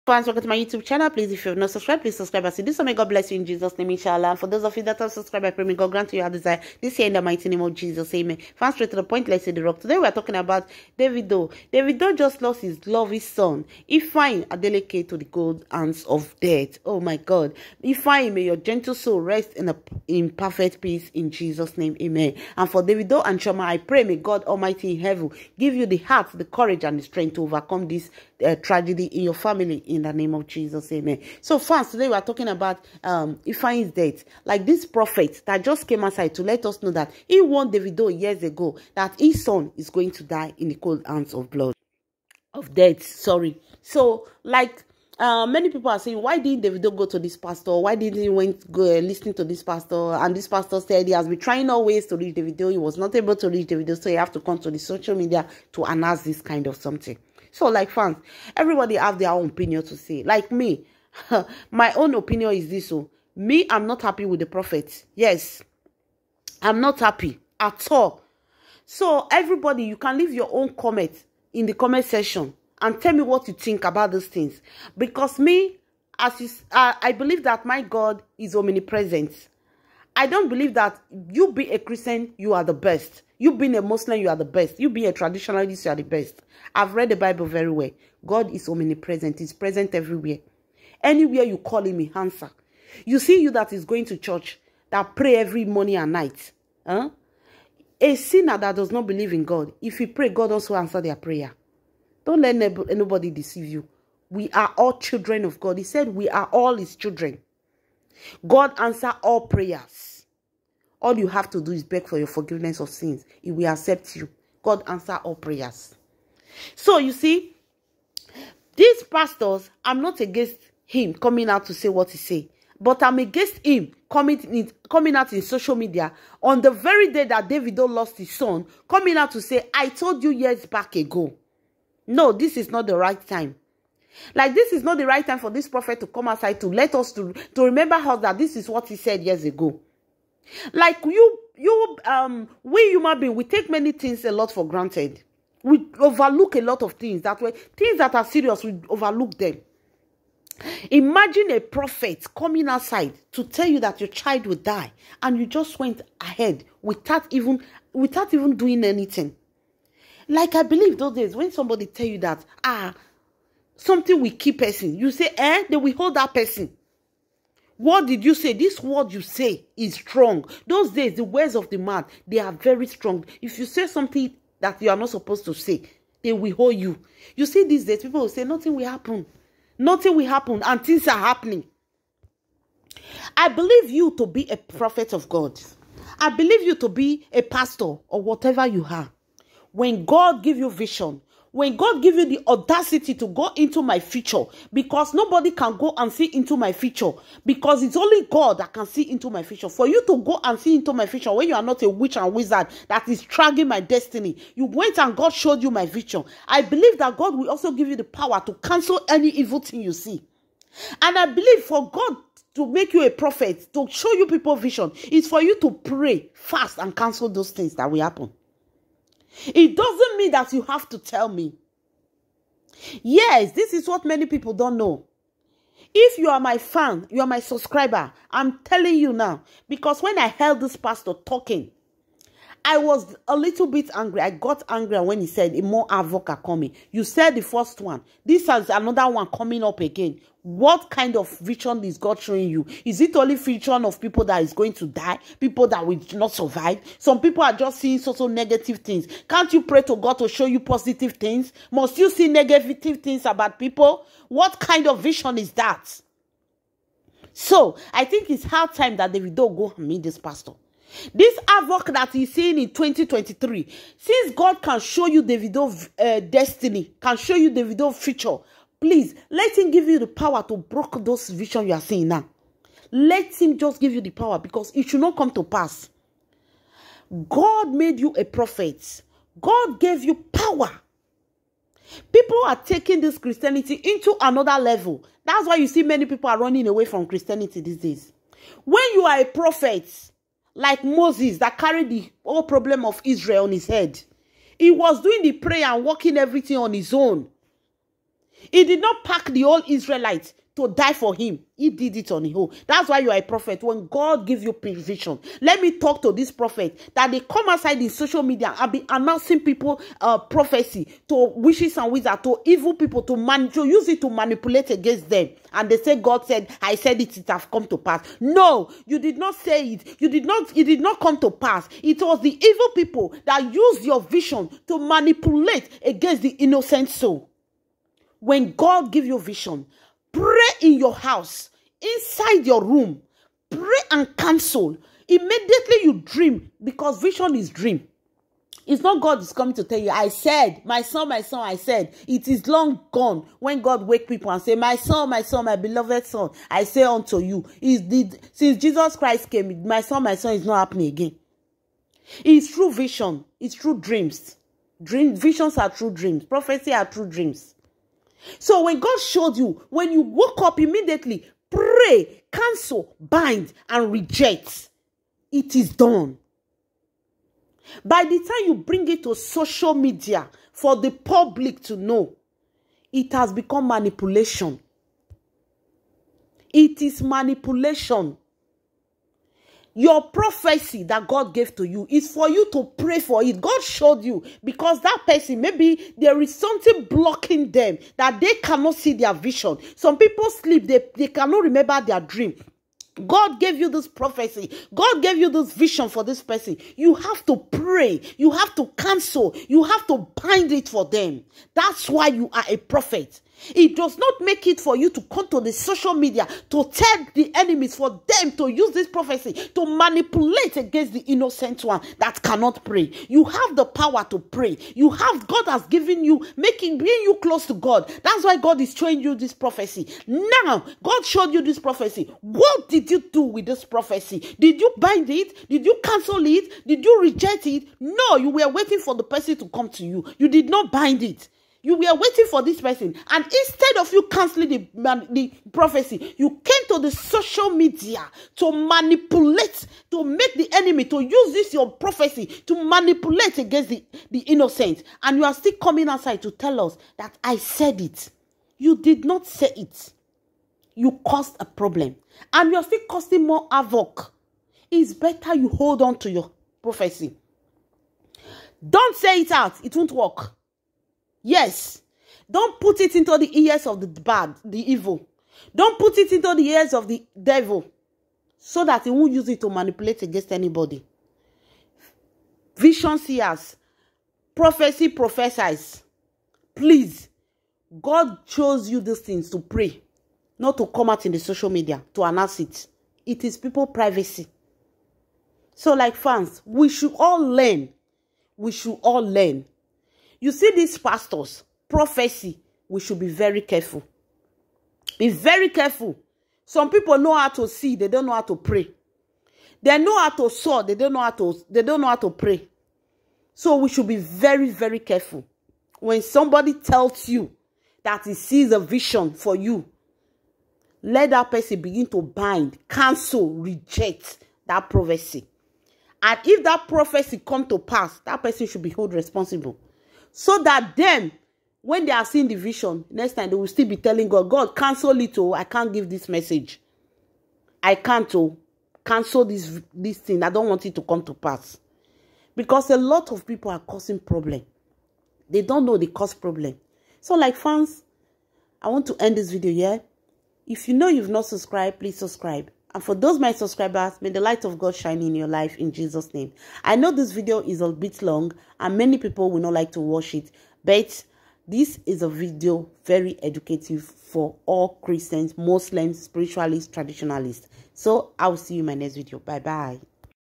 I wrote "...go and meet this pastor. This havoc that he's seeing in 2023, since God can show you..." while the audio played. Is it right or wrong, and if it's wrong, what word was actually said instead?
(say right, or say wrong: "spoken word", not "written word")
right.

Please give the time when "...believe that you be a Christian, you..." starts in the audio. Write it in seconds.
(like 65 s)
80 s.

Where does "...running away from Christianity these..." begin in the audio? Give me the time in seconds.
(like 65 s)
286 s.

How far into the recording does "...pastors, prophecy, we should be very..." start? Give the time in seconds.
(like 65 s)
490 s.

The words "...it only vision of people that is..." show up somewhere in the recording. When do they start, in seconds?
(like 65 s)
243 s.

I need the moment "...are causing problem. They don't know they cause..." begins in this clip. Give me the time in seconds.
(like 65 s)
533 s.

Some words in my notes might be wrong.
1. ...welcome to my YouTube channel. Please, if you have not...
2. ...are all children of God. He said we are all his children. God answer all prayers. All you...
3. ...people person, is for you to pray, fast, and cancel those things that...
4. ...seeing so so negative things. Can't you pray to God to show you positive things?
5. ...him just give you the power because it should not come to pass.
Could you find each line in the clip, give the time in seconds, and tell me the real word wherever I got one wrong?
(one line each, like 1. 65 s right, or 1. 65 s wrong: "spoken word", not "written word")
1. 0 s right
2. 104 s right
3. 214 s wrong: "vision", not "person"
4. 247 s right
5. 273 s right.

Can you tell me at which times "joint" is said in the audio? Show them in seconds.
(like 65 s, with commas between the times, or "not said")
not said.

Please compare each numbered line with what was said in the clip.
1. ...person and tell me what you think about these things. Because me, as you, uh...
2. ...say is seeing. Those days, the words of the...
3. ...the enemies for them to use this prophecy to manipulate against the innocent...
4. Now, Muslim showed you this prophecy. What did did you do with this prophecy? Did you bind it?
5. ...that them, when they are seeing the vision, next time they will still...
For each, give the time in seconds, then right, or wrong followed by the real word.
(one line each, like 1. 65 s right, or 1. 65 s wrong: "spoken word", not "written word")
1. 72 s wrong: "section", not "person"
2. 169 s wrong: "strong", not "seeing"
3. 407 s right
4. 420 s wrong: "God", not "Muslim"
5. 520 s right.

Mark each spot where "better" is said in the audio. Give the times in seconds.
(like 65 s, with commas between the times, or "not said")
454 s.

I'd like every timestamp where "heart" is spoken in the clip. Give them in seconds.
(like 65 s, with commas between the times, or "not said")
25 s.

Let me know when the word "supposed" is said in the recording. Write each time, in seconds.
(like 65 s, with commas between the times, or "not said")
175 s.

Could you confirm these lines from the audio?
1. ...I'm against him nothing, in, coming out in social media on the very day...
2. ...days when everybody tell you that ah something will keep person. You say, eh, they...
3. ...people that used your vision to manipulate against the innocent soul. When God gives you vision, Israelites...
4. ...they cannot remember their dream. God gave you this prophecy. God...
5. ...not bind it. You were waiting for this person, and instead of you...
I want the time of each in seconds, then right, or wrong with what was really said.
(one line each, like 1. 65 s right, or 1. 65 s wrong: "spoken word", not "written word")
1. 123 s wrong: "coming", not "nothing"
2. 161 s wrong: "somebody", not "everybody"
3. 322 s wrong: "Pray", not "Israelites"
4. 390 s right
5. 430 s right.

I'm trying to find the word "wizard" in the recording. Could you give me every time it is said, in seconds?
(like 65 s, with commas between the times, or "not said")
202 s, 311 s.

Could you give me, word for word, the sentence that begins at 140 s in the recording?
Like you, you, um, we human being, we take many things a lot for granted.